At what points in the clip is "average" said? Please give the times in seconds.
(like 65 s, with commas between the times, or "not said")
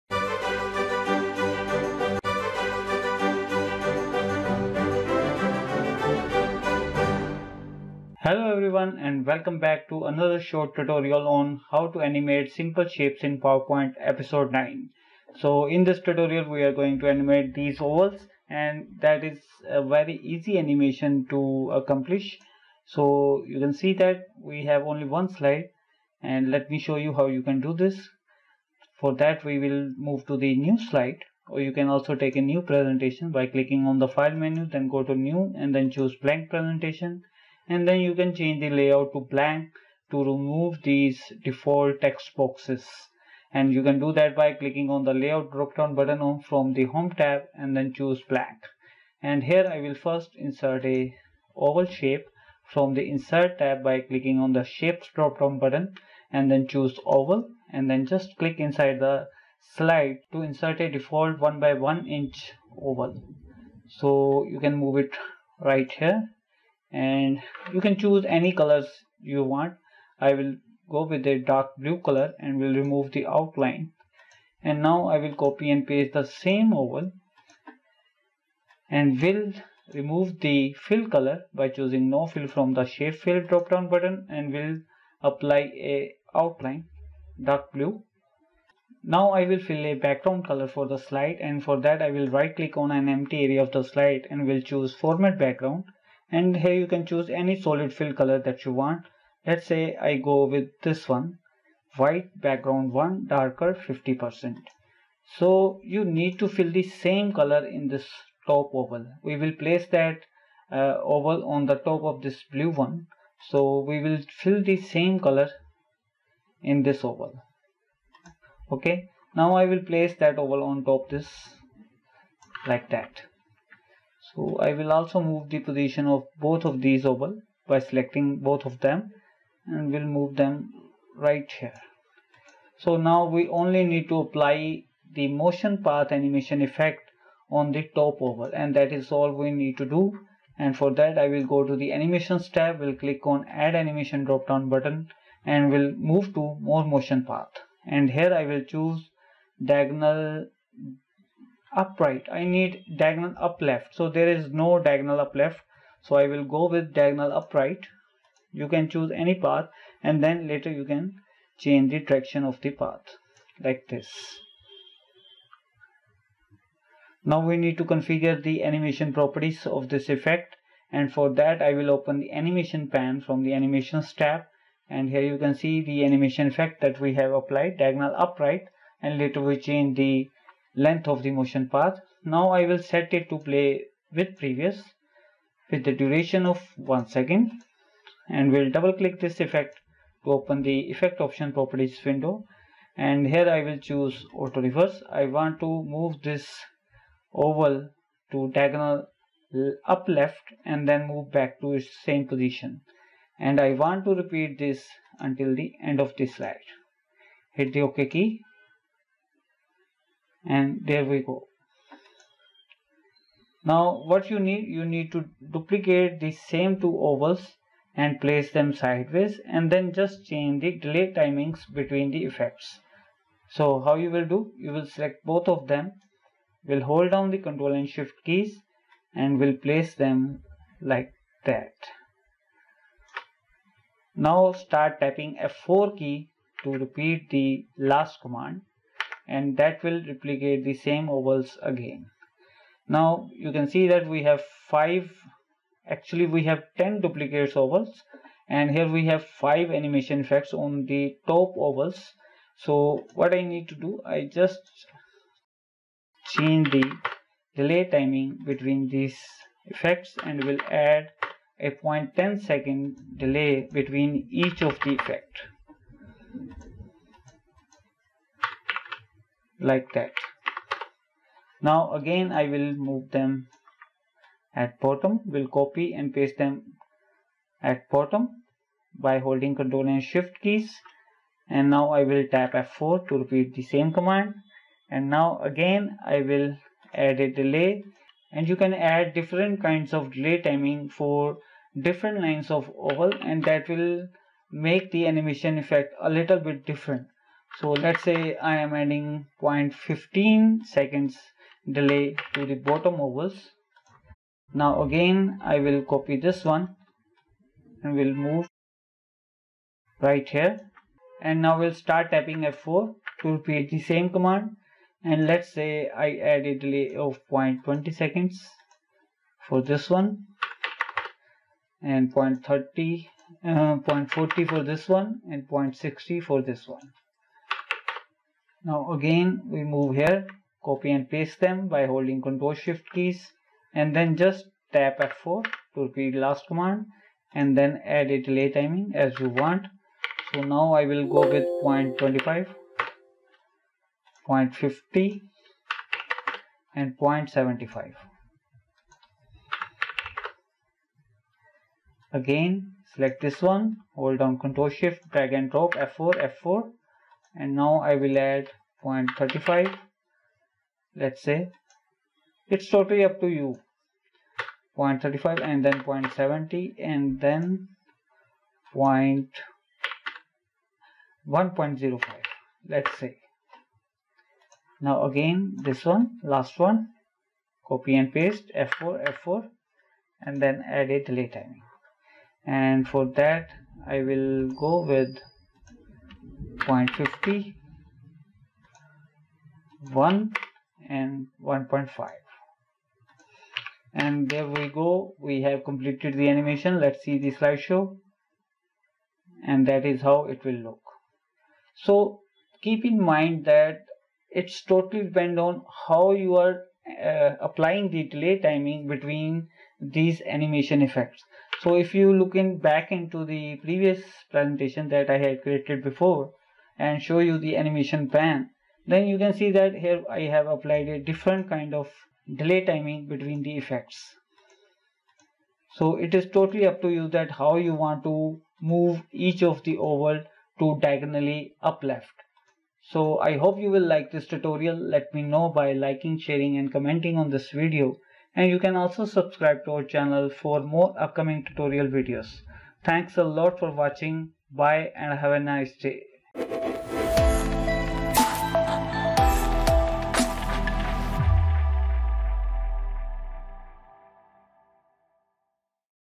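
not said.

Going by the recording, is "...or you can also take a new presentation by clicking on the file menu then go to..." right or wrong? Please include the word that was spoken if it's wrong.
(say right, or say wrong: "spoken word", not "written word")
right.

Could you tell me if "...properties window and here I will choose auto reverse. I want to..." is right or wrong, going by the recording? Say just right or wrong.
right.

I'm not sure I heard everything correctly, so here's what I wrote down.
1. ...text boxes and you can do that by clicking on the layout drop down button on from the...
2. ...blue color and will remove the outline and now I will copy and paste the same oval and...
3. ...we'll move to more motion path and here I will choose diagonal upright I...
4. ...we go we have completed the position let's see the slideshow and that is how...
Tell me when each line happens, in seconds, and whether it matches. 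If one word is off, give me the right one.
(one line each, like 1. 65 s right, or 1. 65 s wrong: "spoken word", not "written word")
1. 42 s right
2. 71 s right
3. 145 s right
4. 394 s wrong: "animation", not "position".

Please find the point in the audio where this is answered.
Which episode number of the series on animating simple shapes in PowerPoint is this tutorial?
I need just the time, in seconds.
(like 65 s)
13 s.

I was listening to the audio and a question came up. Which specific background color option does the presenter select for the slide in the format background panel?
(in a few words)
White, Background 1, Darker 50%.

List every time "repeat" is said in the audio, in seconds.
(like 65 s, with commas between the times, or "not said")
204 s, 236 s, 283 s, 313 s, 335 s.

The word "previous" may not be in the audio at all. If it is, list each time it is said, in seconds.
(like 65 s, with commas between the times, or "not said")
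184 s, 413 s.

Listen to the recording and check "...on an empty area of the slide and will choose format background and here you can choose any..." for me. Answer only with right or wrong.
right.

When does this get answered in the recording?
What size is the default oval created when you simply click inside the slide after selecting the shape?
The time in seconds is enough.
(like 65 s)
61 s.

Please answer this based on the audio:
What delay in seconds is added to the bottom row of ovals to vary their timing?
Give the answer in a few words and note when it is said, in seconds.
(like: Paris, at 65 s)
0.15 seconds, at 299 s.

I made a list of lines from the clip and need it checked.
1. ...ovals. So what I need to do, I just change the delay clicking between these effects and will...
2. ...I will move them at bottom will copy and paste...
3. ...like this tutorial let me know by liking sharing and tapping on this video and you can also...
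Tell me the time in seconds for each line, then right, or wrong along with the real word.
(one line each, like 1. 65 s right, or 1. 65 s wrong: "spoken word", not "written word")
1. 251 s wrong: "timing", not "clicking"
2. 272 s right
3. 433 s wrong: "commenting", not "tapping".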